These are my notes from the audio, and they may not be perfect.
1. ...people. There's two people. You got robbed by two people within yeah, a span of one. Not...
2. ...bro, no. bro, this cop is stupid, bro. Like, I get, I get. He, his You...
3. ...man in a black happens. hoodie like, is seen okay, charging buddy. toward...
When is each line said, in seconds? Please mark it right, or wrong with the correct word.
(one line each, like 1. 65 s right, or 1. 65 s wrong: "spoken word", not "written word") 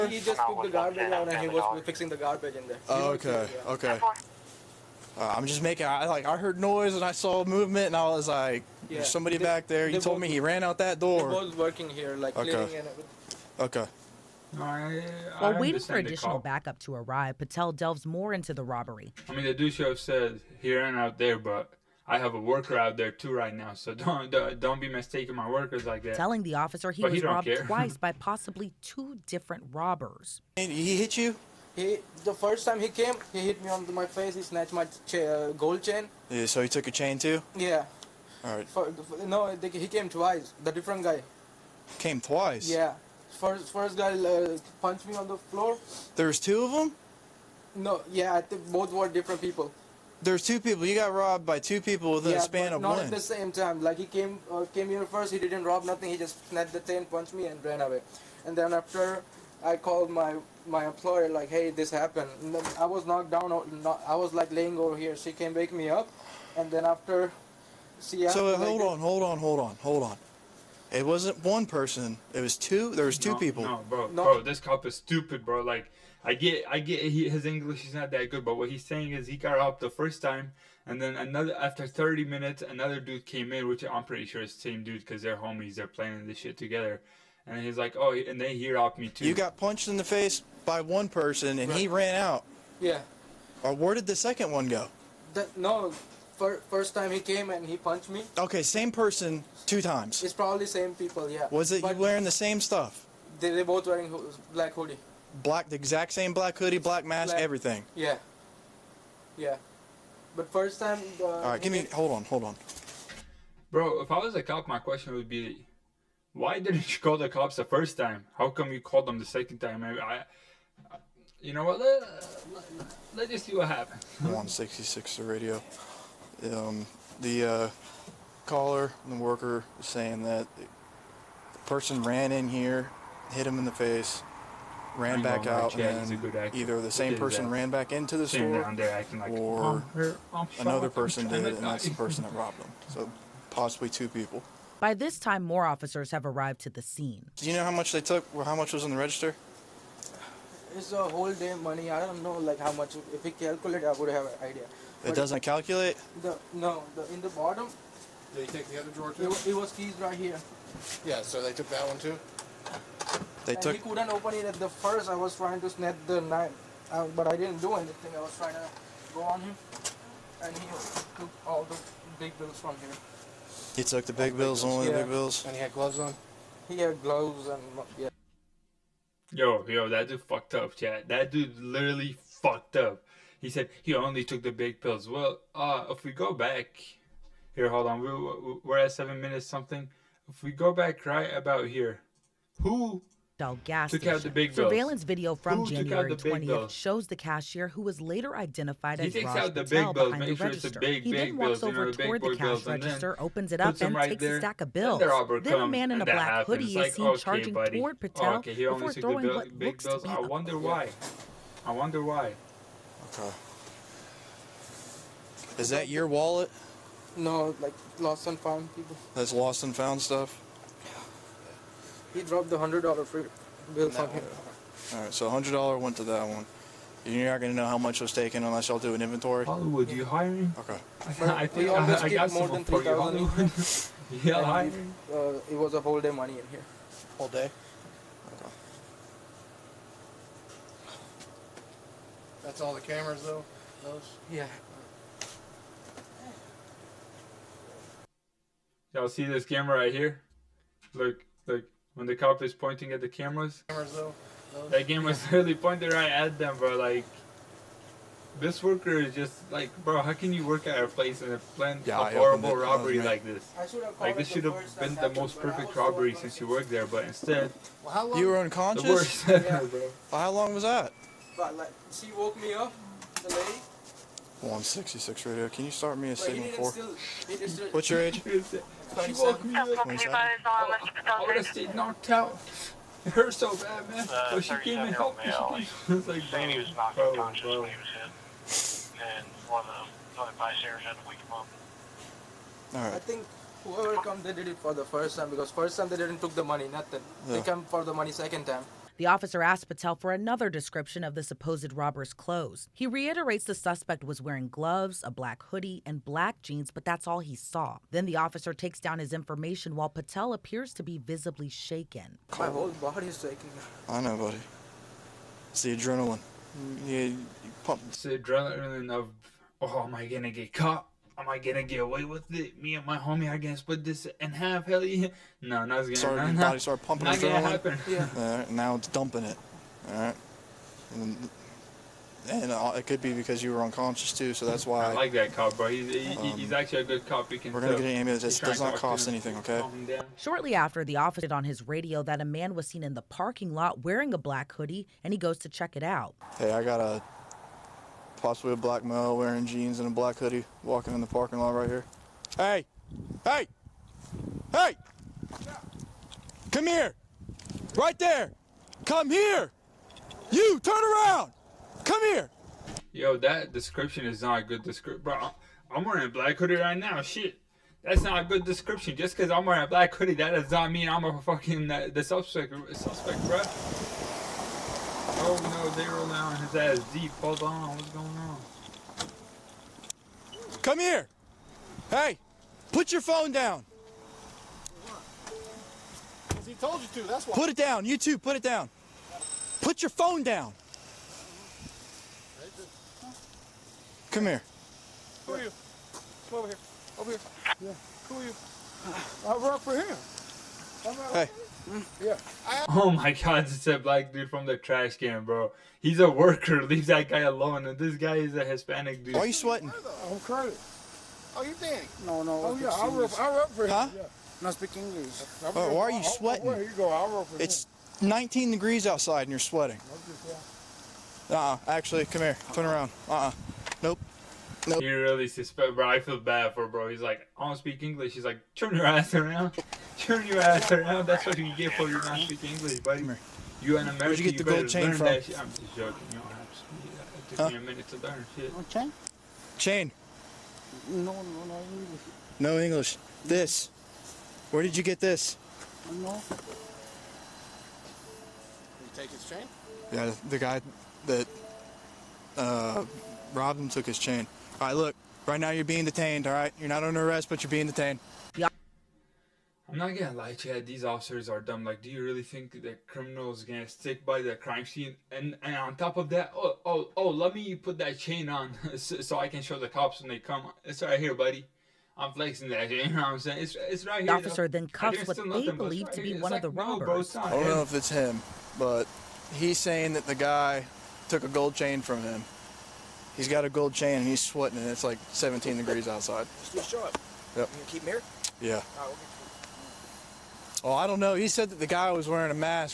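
1. 49 s right
2. 73 s wrong: "English", not "You"
3. 205 s right.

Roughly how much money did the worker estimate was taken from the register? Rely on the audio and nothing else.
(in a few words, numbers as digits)
More than 3000.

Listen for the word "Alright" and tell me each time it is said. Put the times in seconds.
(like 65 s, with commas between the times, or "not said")
224 s, 292 s.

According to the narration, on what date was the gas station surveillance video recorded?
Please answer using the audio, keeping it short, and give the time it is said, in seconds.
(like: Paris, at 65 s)
January 20th, at 195 s.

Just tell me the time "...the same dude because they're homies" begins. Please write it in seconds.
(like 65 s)
84 s.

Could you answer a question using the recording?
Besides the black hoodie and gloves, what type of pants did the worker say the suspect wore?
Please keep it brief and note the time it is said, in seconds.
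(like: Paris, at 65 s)
Black jeans, at 306 s.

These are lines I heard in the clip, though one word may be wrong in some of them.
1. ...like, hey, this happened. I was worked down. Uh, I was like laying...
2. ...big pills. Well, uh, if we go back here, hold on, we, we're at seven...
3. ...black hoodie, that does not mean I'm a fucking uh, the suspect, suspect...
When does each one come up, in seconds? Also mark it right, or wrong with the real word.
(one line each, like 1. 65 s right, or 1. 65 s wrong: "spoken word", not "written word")
1. 61 s wrong: "knocked", not "worked"
2. 184 s right
3. 369 s right.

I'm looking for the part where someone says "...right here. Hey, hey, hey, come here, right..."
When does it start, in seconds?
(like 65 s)
351 s.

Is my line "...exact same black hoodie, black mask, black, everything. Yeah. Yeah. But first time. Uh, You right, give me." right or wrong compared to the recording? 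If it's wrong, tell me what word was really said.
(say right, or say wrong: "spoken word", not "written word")
wrong: "All", not "You".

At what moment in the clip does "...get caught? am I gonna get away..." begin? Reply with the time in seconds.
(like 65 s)
320 s.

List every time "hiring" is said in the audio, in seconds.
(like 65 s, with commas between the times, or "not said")
230 s, 234 s.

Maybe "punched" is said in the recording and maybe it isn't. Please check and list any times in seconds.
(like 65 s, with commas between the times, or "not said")
44 s, 57 s, 89 s, 97 s.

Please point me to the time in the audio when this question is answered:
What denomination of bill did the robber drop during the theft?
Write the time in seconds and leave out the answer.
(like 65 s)
222 s.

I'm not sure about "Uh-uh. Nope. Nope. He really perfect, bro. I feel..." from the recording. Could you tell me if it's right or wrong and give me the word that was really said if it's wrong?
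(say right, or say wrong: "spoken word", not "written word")
wrong: "suspect", not "perfect".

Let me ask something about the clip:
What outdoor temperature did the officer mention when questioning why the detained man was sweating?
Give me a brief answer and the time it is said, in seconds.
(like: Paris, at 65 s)
19 degrees, at 418 s.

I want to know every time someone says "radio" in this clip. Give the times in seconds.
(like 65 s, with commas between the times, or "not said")
125 s, 275 s, 341 s.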